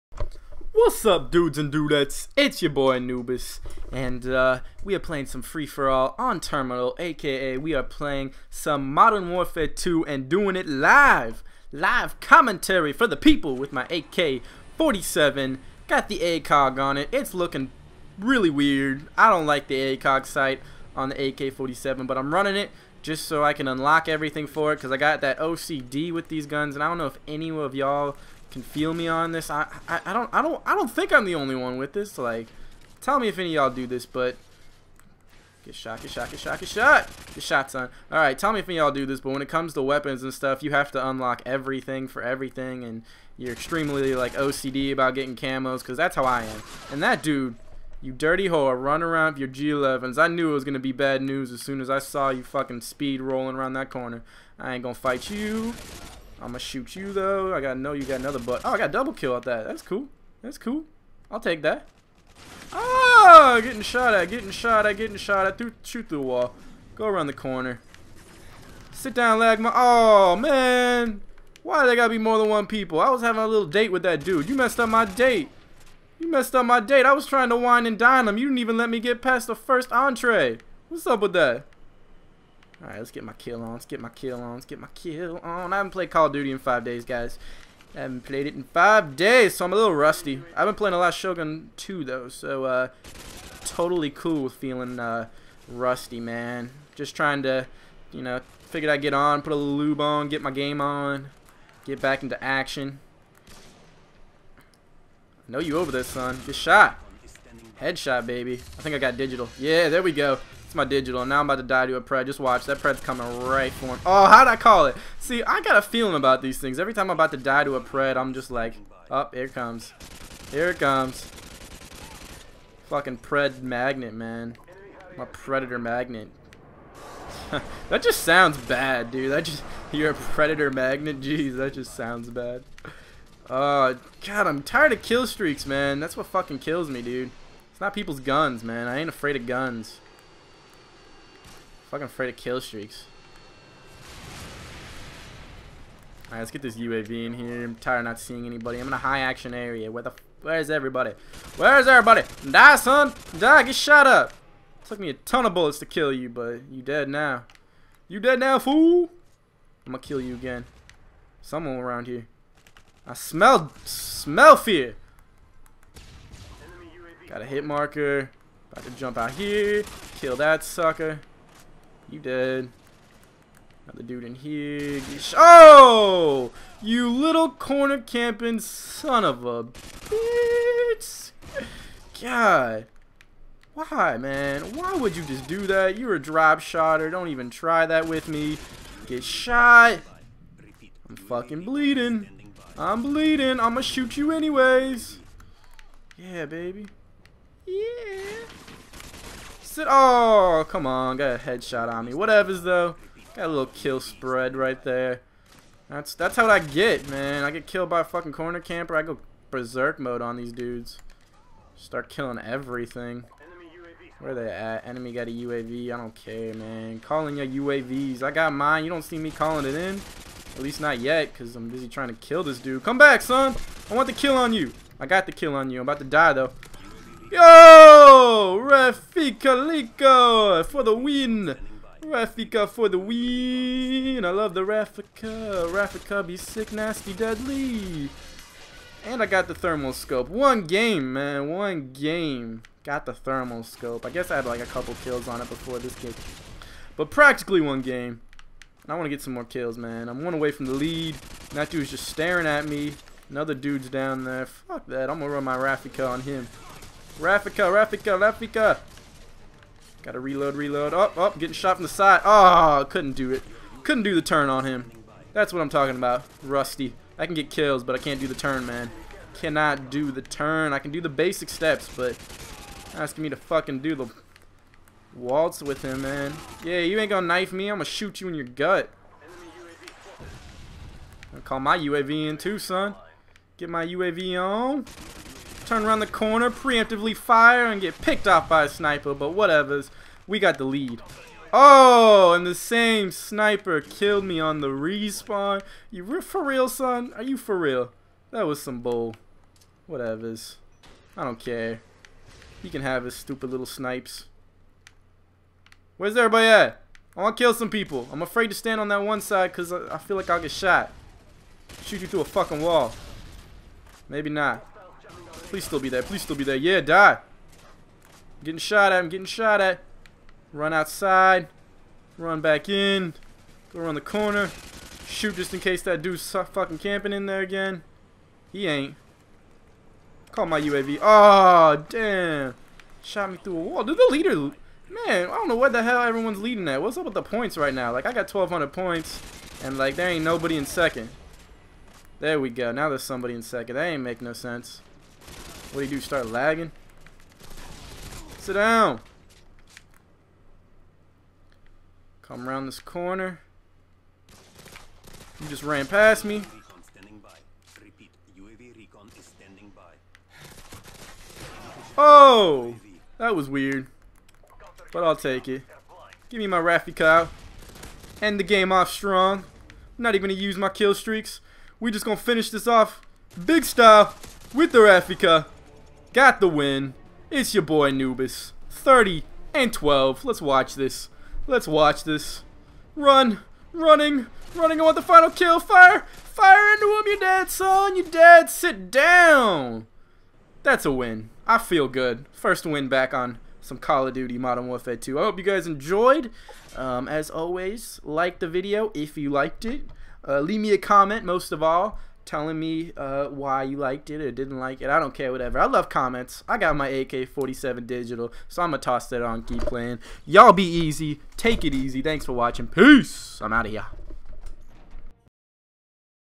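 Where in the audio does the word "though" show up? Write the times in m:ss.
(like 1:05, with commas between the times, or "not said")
0:57, 1:32, 3:22, 3:46.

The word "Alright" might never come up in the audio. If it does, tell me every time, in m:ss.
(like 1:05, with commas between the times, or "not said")
0:38, 1:22, 2:26.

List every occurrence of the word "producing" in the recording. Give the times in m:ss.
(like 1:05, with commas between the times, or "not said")
not said.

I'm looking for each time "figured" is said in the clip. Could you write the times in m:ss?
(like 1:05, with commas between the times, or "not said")
1:38.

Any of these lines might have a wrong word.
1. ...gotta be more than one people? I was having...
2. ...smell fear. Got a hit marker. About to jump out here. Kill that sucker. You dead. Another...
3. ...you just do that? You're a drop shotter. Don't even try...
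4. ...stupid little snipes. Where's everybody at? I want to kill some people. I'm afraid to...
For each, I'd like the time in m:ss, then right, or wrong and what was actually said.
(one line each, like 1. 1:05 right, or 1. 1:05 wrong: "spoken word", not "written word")
1. 1:11 right
2. 2:43 right
3. 3:05 right
4. 5:03 right.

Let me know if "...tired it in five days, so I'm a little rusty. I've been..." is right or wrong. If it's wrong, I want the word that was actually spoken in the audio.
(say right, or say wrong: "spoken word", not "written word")
wrong: "played", not "tired".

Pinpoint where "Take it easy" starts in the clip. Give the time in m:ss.
6:51.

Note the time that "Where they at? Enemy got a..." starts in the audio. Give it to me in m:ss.
3:34.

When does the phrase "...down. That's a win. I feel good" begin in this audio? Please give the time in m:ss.
6:28.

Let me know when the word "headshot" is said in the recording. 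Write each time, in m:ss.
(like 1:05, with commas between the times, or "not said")
1:47, 3:21.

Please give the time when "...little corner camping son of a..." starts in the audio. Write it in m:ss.
2:57.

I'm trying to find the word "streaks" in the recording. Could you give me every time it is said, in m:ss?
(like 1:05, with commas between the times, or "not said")
2:15, 2:22, 6:10.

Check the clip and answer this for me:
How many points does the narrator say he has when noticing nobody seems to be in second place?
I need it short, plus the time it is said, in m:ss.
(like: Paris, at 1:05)
1,200, at 5:38.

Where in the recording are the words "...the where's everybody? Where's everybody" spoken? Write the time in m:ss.
2:30.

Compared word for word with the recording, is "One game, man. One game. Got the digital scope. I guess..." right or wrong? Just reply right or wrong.
wrong.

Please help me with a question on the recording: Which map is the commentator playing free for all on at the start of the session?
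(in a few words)
Terminal.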